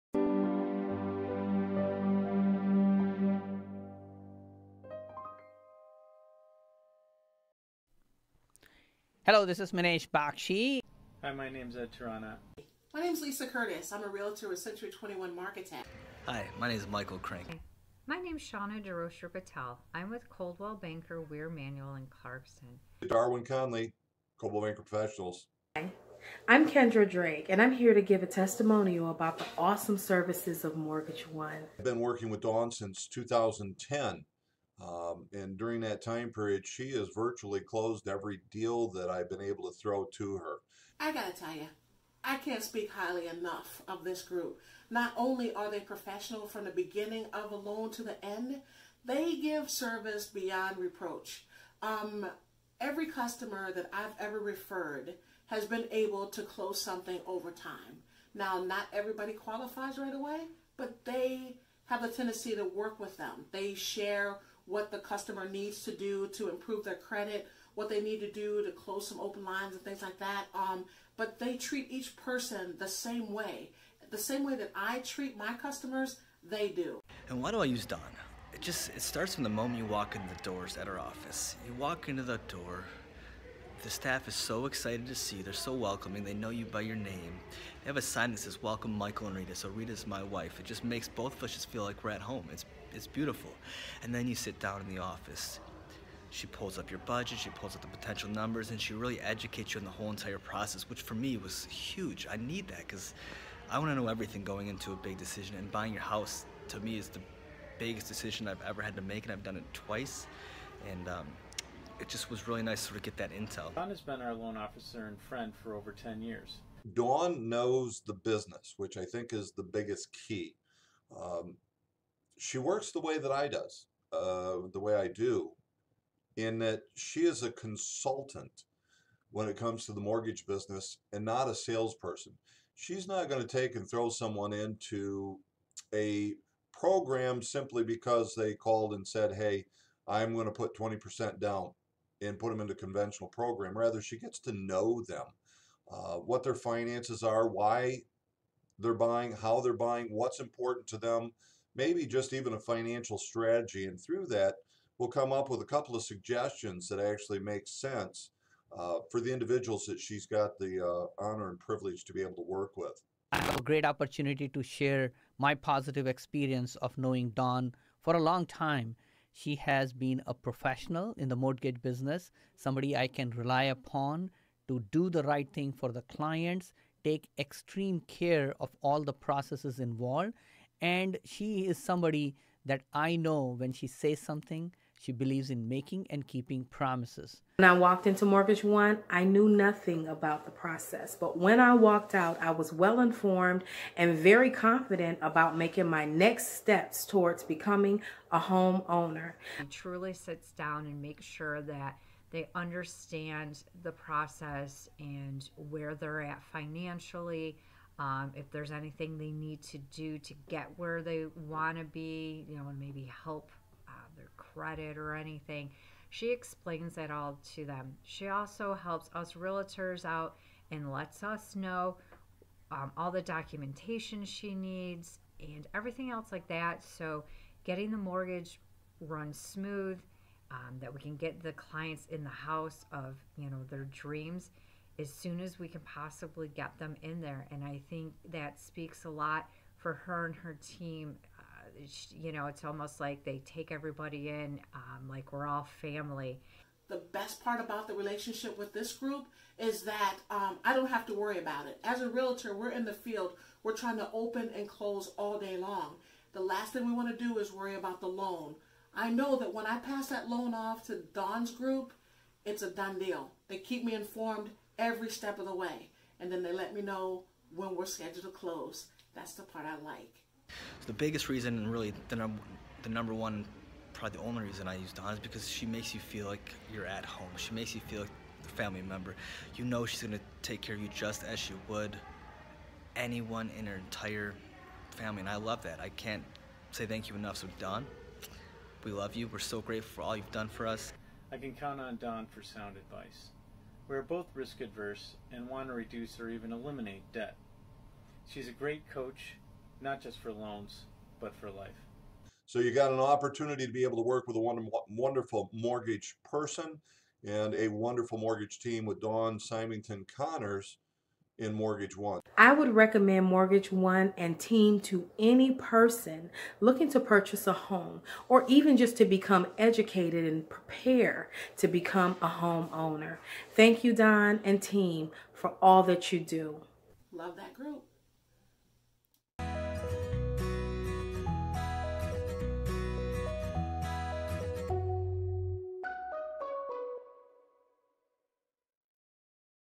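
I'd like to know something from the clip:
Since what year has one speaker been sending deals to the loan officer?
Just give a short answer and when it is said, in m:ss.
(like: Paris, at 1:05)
2010, at 0:33.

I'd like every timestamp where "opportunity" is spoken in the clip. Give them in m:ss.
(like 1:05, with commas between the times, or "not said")
2:43, 5:03.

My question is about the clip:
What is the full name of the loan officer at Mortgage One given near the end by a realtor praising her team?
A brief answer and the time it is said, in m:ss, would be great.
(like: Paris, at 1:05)
Dawn Symington Connors, at 5:09.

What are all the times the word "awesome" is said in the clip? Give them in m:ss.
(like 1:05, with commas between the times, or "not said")
0:29.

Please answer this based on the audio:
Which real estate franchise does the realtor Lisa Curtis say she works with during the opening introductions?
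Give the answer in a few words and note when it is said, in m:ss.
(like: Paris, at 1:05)
Century 21, at 0:14.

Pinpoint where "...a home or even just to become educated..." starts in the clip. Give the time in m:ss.
5:17.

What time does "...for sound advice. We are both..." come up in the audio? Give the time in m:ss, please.
4:52.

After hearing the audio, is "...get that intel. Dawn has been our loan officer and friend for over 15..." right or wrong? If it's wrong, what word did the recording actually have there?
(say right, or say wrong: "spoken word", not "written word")
wrong: "10", not "15".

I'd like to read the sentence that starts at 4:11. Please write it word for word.
As a realtor, we're in the field, we're trying to open and close all day long.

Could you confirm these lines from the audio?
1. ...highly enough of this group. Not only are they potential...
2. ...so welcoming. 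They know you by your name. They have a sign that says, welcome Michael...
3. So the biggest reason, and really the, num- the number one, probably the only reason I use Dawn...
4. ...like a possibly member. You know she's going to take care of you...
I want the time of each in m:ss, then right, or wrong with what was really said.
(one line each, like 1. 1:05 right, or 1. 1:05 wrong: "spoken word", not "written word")
1. 0:42 wrong: "professional", not "potential"
2. 1:25 right
3. 4:30 right
4. 4:38 wrong: "family", not "possibly".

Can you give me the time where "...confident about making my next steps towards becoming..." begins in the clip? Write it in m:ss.
3:14.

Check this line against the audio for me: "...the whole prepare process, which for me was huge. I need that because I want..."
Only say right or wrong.
wrong.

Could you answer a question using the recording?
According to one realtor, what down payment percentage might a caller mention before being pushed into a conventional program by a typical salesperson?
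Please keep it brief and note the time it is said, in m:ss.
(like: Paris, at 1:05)
20%, at 2:20.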